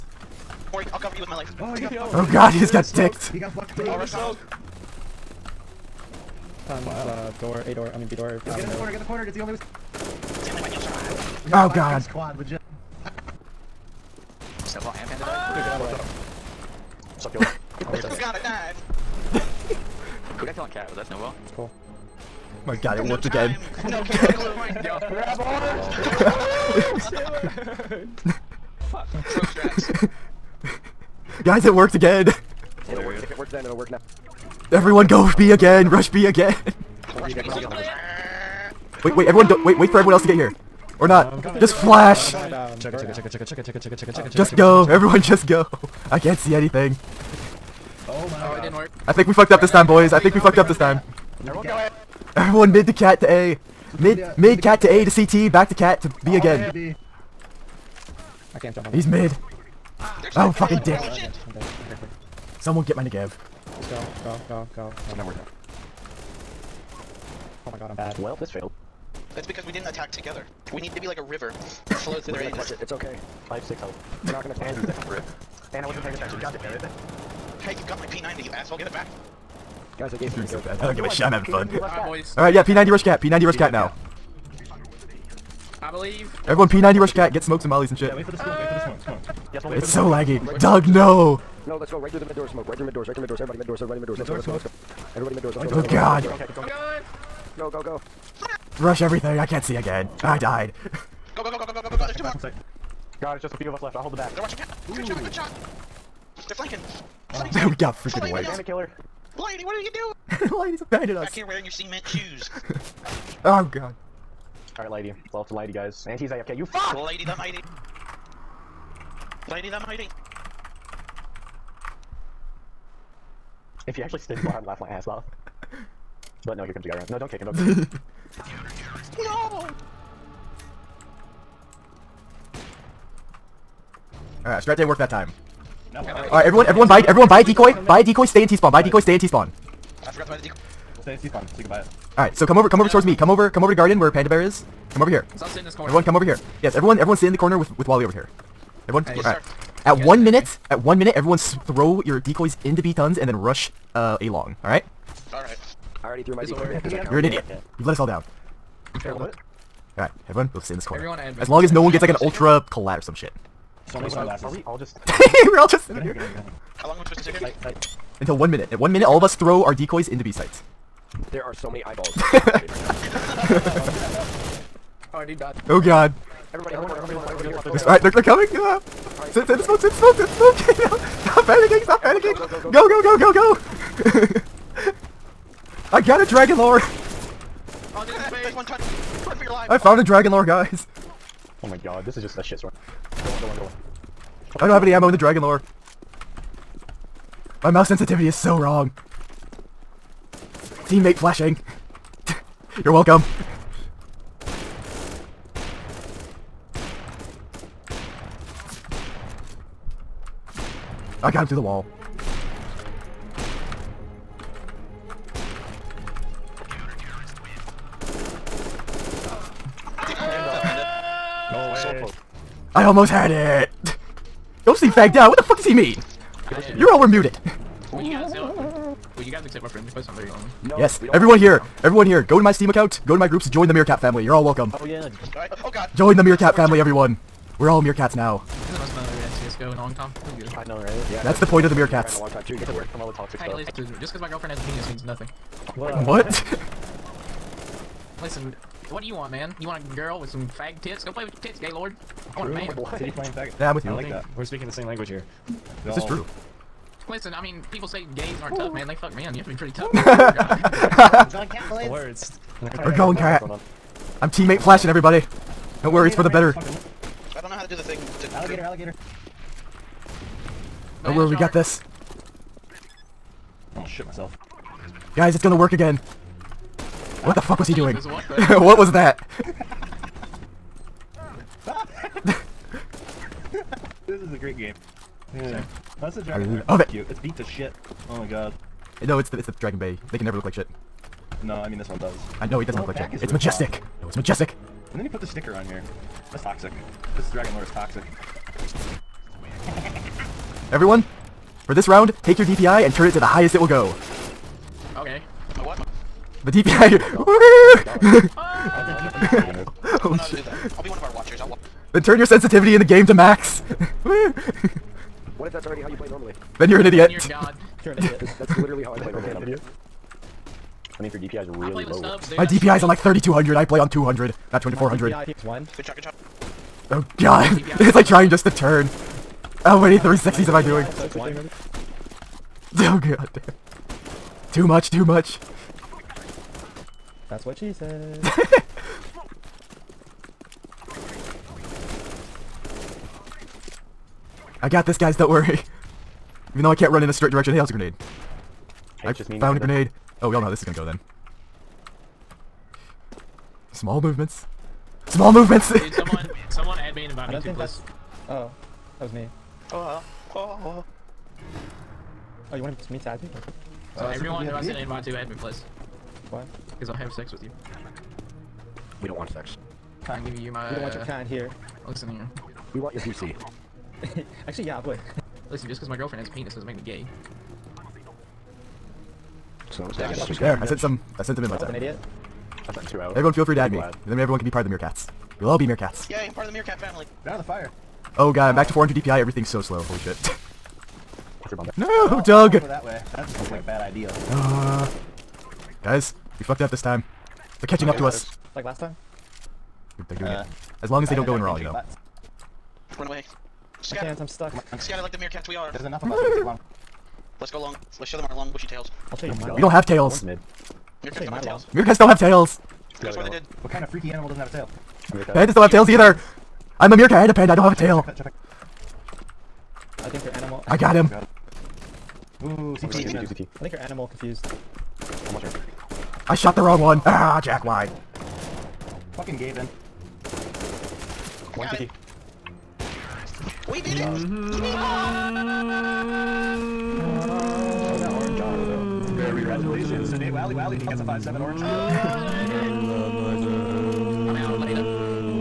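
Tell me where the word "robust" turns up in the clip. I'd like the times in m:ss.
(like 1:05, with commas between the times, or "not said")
not said.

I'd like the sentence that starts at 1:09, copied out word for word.
That's because we didn't attack together.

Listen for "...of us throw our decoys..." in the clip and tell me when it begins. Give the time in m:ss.
2:49.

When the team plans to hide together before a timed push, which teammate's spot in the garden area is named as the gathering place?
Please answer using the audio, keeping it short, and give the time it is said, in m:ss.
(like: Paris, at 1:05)
Panda Bear, at 2:24.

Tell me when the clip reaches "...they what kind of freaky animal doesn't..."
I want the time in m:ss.
6:53.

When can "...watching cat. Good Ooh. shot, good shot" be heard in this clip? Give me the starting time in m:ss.
1:44.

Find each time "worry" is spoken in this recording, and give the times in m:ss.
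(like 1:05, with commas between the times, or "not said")
0:00, 4:25, 5:45.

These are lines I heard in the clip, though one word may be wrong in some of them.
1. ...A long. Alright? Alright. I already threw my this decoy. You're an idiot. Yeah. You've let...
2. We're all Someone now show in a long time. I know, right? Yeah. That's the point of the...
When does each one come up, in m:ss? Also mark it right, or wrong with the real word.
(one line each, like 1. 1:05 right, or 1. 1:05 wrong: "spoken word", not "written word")
1. 2:34 right
2. 3:57 wrong: "Meerkats", not "Someone".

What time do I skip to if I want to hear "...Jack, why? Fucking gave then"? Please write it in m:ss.
7:07.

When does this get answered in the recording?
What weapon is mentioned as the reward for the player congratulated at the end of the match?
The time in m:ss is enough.
7:21.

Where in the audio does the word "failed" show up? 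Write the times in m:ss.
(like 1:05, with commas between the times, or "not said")
1:08.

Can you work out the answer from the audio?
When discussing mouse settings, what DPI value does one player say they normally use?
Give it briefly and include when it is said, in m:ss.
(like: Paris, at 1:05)
3200, at 5:22.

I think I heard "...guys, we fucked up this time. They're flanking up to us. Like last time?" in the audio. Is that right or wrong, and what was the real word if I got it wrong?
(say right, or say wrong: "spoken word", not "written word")
wrong: "catching", not "flanking".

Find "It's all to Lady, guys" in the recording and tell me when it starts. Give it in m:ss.
1:55.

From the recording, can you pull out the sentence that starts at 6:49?
I'll show you oh my We don't have tails.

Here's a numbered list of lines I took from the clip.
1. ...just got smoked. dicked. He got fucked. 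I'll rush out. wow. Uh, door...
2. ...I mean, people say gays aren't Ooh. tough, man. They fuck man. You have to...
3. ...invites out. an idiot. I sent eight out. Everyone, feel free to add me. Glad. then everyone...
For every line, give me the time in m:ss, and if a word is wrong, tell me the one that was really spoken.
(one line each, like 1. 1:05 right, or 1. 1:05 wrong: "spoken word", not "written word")
1. 0:02 right
2. 4:17 right
3. 6:21 wrong: "two", not "eight".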